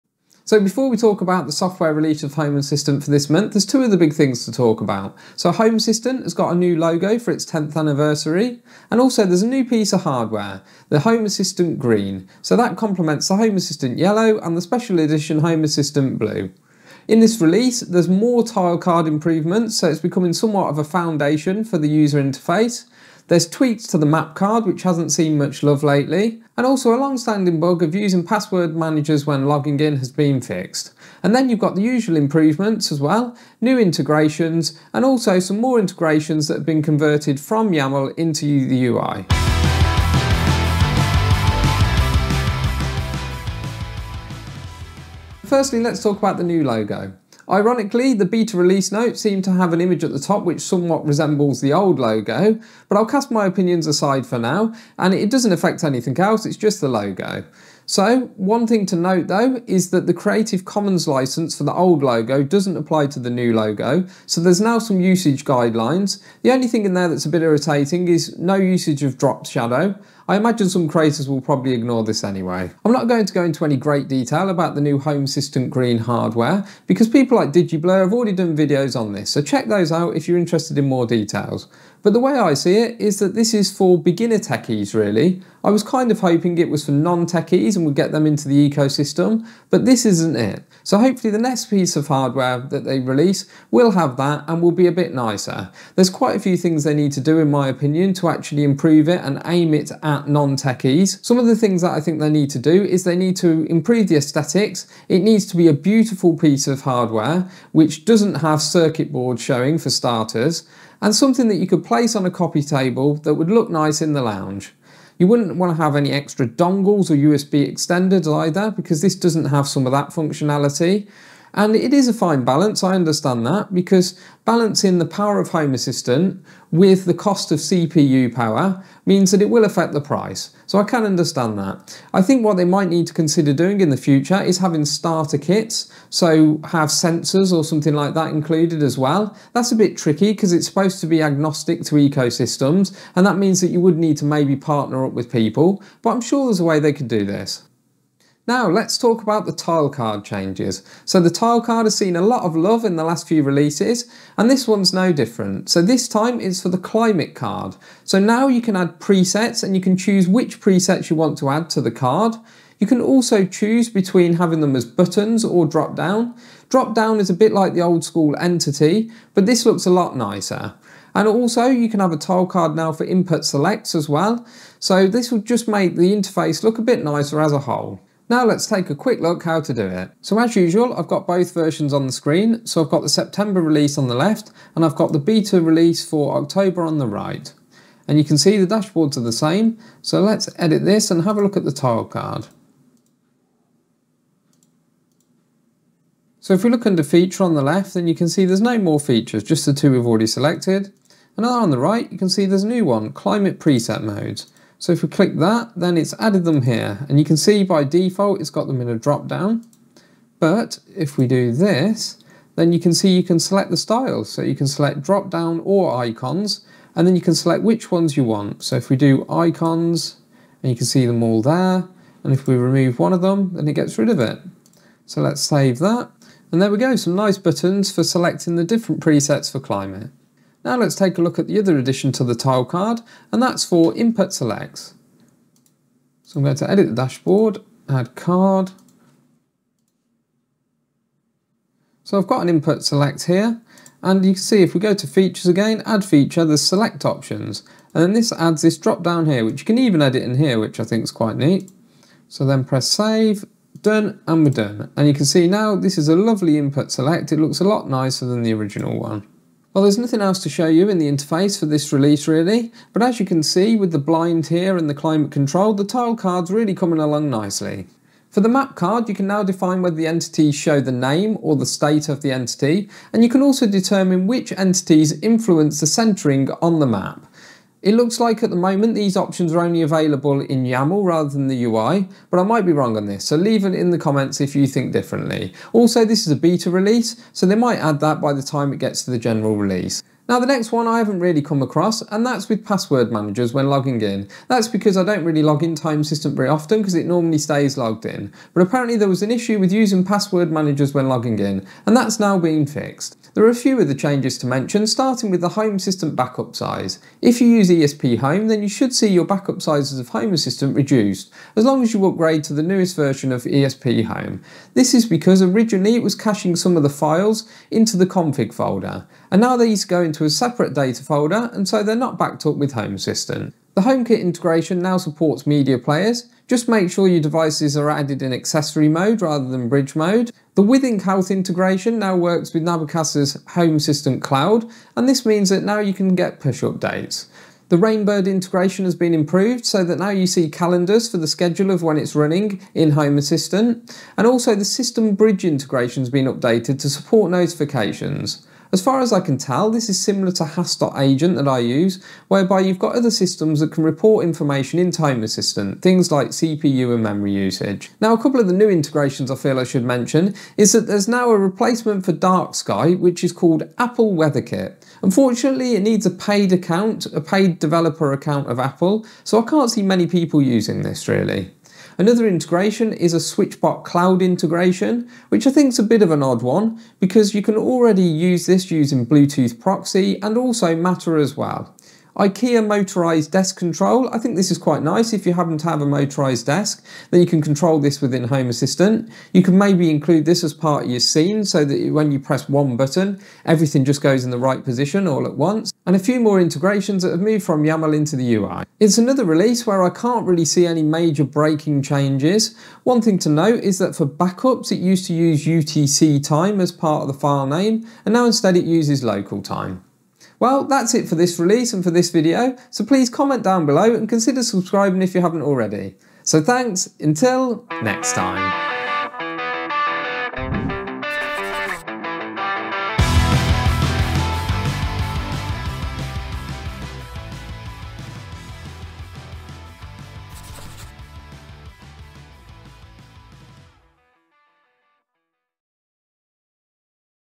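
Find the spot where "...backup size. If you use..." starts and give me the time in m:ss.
5:06.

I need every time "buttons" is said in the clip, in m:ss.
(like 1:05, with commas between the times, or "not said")
2:44, 3:47, 6:32.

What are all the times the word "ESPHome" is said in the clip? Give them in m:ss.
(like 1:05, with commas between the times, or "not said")
5:07, 5:13.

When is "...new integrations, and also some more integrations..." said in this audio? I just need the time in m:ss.
0:33.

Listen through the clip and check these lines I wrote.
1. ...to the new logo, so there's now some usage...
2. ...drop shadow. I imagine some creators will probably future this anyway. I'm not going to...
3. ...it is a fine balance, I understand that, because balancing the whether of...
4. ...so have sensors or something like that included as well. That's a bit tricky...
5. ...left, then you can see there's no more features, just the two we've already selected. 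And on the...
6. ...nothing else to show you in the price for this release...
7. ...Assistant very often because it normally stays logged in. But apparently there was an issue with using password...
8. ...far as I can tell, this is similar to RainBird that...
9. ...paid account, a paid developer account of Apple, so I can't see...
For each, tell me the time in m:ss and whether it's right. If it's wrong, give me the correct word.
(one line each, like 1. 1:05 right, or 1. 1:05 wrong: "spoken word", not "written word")
1. 1:03 right
2. 1:09 wrong: "ignore", not "future"
3. 2:01 wrong: "power", not "whether"
4. 2:16 right
5. 3:17 right
6. 4:19 wrong: "interface", not "price"
7. 4:56 right
8. 5:48 wrong: "Agent", not "RainBird"
9. 6:06 right.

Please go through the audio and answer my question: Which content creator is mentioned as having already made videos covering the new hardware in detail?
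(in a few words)
DigiBlur.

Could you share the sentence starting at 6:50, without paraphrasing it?
Well, that's it for this release and for this video, so please comment down below and consider subscribing if you haven't already.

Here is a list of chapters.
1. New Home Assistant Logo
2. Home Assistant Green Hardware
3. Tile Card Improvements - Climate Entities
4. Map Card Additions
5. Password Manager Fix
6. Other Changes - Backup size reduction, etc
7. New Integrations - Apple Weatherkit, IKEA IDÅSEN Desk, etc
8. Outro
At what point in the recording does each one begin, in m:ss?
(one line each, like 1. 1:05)
1. 0:45
2. 1:12
3. 2:27
4. 4:27
5. 4:49
6. 5:03
7. 5:57
8. 6:38.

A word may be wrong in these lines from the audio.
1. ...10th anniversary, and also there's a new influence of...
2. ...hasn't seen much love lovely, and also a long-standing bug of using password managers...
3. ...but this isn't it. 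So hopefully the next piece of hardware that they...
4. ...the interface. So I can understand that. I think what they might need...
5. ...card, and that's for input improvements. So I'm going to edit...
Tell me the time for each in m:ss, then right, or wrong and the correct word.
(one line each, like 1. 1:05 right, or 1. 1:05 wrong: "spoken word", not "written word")
1. 0:07 wrong: "piece", not "influence"
2. 0:24 wrong: "lately", not "lovely"
3. 1:29 right
4. 2:09 wrong: "price", not "interface"
5. 3:52 wrong: "selects", not "improvements".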